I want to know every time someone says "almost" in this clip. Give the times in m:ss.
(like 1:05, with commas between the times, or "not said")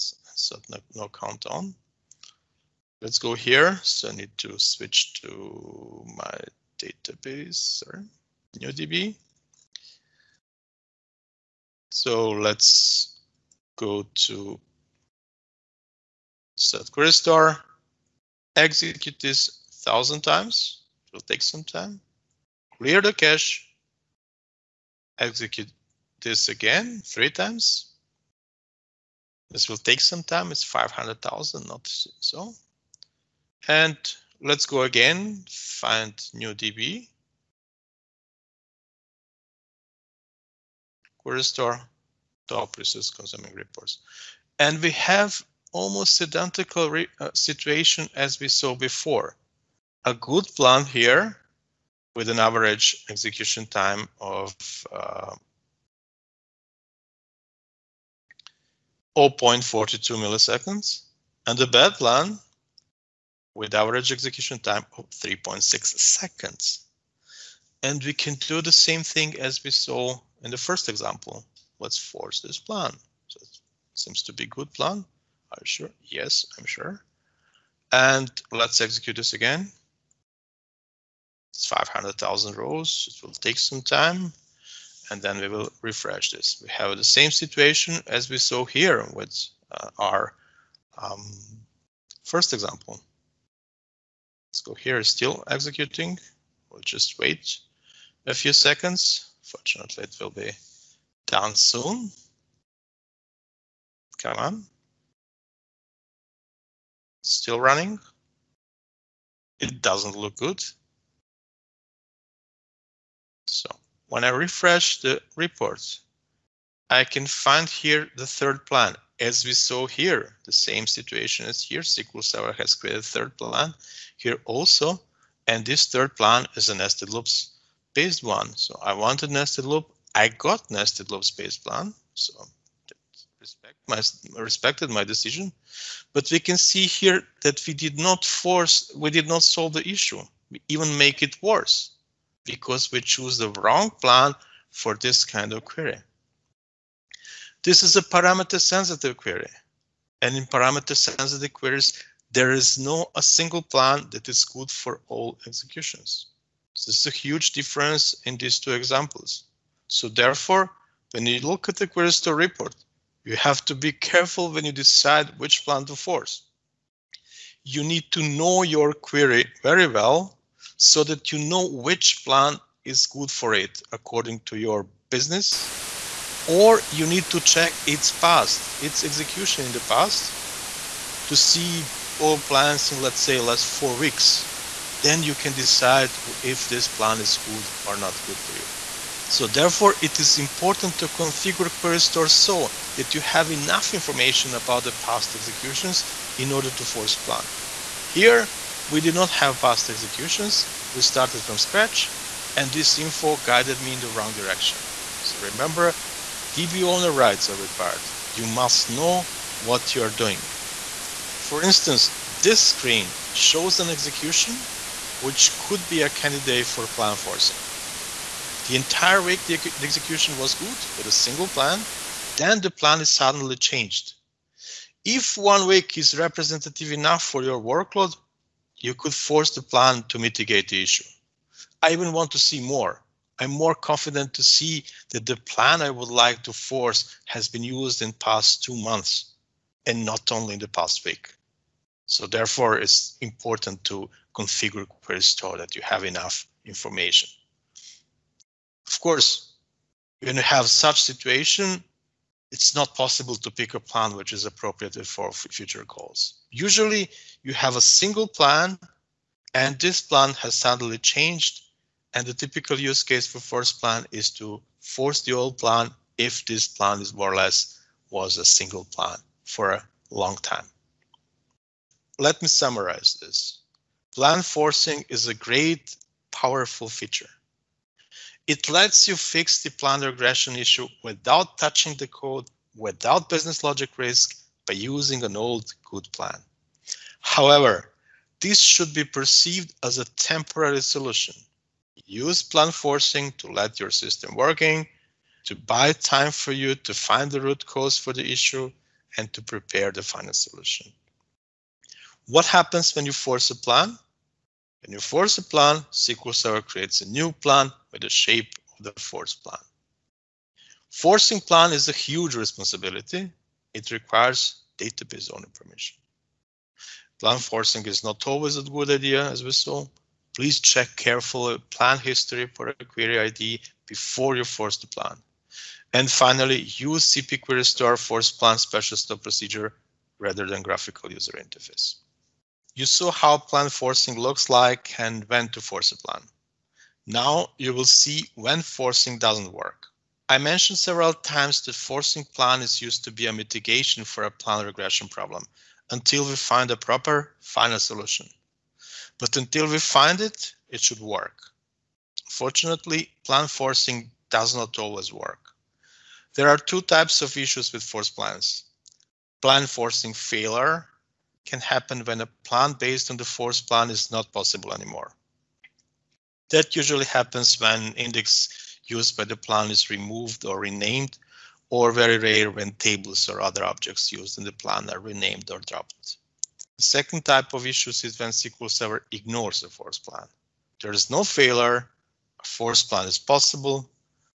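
0:45.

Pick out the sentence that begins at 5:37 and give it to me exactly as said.
Now you will see when forcing doesn't work.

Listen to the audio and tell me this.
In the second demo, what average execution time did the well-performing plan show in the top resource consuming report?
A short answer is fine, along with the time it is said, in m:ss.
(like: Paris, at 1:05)
0.42 milliseconds, at 0:59.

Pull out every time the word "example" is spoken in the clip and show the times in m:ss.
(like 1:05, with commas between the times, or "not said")
1:10, 1:32, 2:38.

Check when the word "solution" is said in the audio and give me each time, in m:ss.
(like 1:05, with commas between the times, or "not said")
4:50, 5:00, 5:47.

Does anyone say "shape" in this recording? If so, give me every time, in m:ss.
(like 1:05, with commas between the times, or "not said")
5:08.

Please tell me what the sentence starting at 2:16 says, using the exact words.
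But we can see here that we did not force, we did not solve the issue.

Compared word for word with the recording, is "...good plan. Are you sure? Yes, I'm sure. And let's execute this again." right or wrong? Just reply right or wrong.
right.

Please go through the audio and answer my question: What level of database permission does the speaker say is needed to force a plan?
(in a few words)
database owner.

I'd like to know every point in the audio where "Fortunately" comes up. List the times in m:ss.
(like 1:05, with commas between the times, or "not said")
1:39, 5:52.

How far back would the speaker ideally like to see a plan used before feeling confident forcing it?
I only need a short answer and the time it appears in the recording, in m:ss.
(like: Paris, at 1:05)
two months, at 3:58.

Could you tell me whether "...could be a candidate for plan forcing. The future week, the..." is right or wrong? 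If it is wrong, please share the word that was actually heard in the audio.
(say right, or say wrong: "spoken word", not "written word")
wrong: "entire", not "future".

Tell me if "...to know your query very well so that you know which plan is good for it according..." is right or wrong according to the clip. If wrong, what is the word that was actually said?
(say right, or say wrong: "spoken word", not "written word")
right.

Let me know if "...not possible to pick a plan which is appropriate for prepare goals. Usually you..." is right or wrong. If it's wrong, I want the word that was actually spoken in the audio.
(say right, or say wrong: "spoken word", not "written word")
wrong: "future", not "prepare".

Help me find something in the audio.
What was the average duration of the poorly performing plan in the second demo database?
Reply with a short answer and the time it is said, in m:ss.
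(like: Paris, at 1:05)
3.6 seconds, at 1:05.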